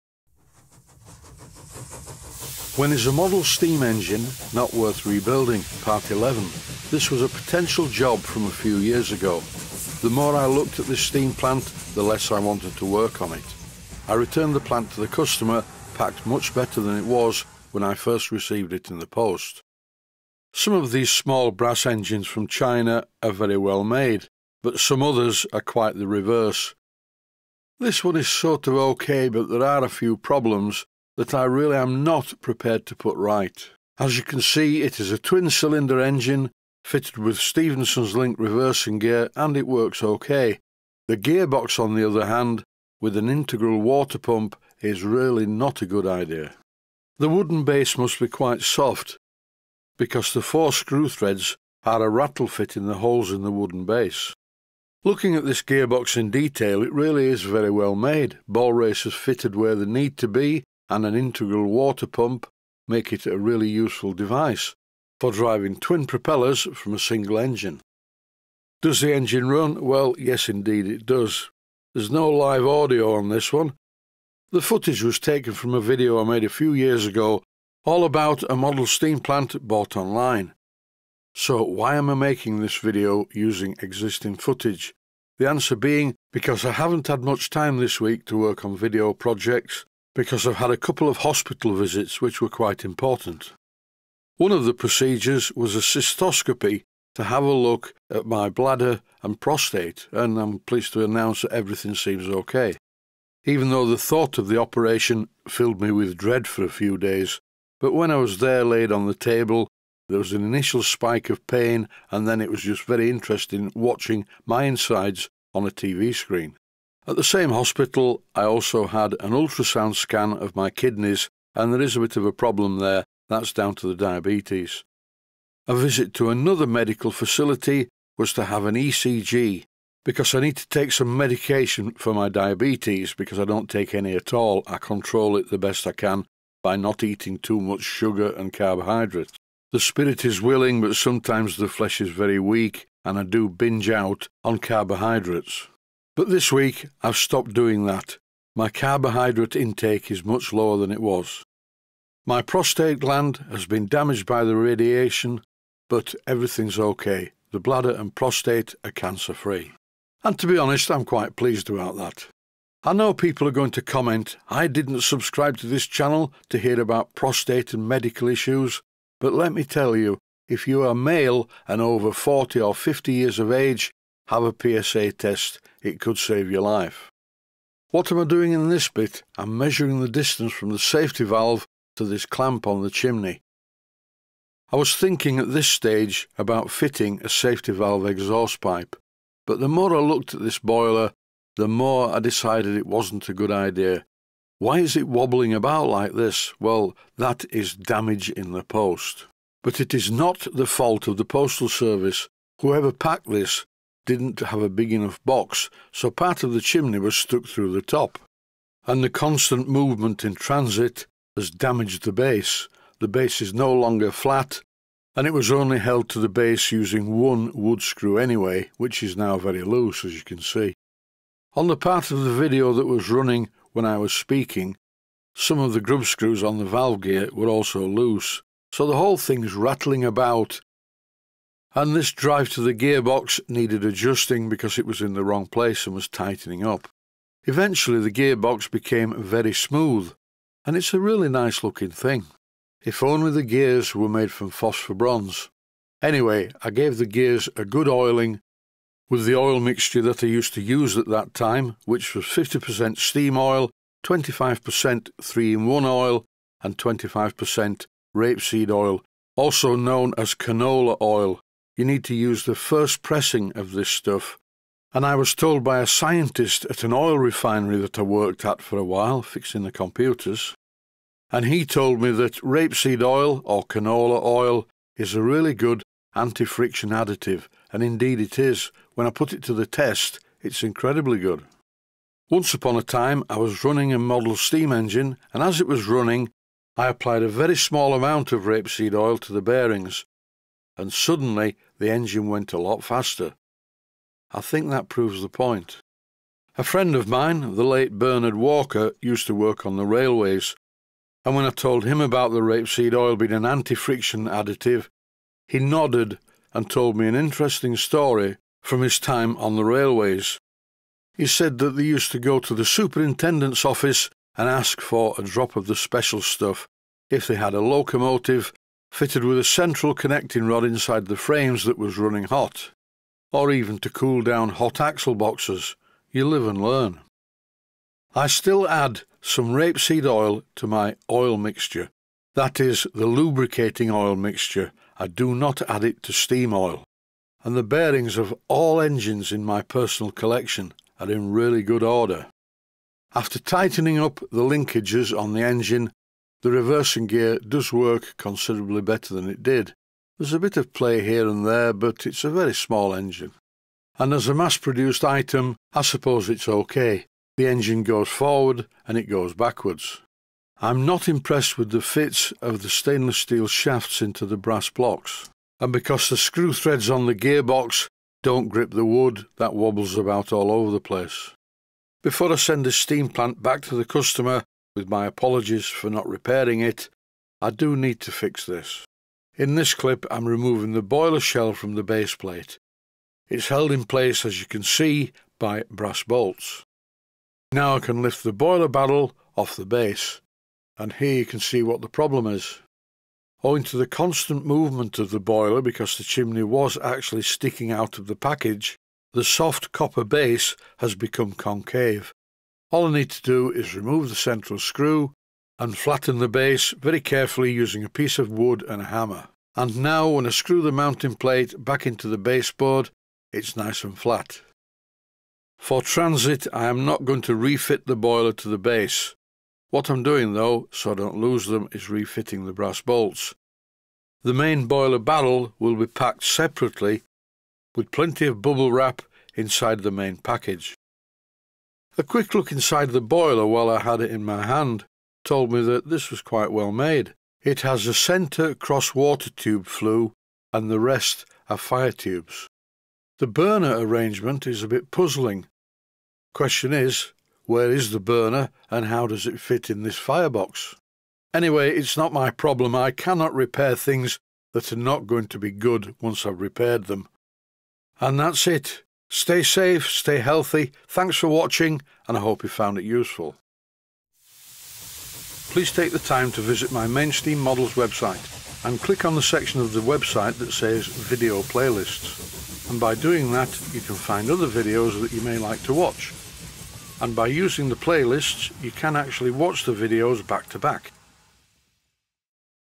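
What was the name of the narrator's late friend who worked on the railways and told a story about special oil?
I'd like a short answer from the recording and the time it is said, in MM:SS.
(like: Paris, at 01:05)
Bernard Walker, at 04:57.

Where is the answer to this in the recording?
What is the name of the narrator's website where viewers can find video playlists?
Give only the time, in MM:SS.
07:46.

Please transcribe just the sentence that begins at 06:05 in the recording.
And because the screw threads on the gearbox don't grip the wood, that wobbles about all over the place.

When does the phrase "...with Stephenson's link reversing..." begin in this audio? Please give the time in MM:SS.
00:37.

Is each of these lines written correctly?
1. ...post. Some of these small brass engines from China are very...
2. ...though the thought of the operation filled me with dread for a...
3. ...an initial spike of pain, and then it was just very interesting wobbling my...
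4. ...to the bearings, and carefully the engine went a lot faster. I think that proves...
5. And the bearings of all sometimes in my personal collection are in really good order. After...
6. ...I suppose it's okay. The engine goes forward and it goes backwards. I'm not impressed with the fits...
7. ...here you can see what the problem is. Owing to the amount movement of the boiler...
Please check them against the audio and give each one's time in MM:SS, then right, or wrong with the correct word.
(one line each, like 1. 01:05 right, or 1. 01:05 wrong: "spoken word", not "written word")
1. 00:19 right
2. 01:43 right
3. 01:50 wrong: "watching", not "wobbling"
4. 04:49 wrong: "suddenly", not "carefully"
5. 05:37 wrong: "engines", not "sometimes"
6. 05:55 right
7. 06:30 wrong: "constant", not "amount".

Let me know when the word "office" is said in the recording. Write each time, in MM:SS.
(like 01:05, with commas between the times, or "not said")
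05:13.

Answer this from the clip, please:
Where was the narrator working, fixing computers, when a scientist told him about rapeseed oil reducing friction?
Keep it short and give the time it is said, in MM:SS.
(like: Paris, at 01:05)
an oil refinery, at 04:26.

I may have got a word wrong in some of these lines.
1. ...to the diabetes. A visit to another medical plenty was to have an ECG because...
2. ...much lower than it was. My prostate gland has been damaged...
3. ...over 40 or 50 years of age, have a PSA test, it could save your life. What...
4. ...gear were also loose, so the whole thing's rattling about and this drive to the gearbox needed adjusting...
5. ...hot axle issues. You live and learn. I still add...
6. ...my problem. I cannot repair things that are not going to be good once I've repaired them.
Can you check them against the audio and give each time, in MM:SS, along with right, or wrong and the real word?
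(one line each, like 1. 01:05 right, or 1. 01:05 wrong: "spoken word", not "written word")
1. 02:03 wrong: "facility", not "plenty"
2. 02:30 right
3. 02:51 right
4. 03:47 right
5. 05:24 wrong: "boxes", not "issues"
6. 07:32 right.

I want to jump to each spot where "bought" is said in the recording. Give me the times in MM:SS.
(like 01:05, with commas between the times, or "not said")
01:19.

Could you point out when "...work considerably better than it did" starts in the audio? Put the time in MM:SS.
05:47.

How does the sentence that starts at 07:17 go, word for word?
It has a centre cross water tube flue and the rest are fire tubes.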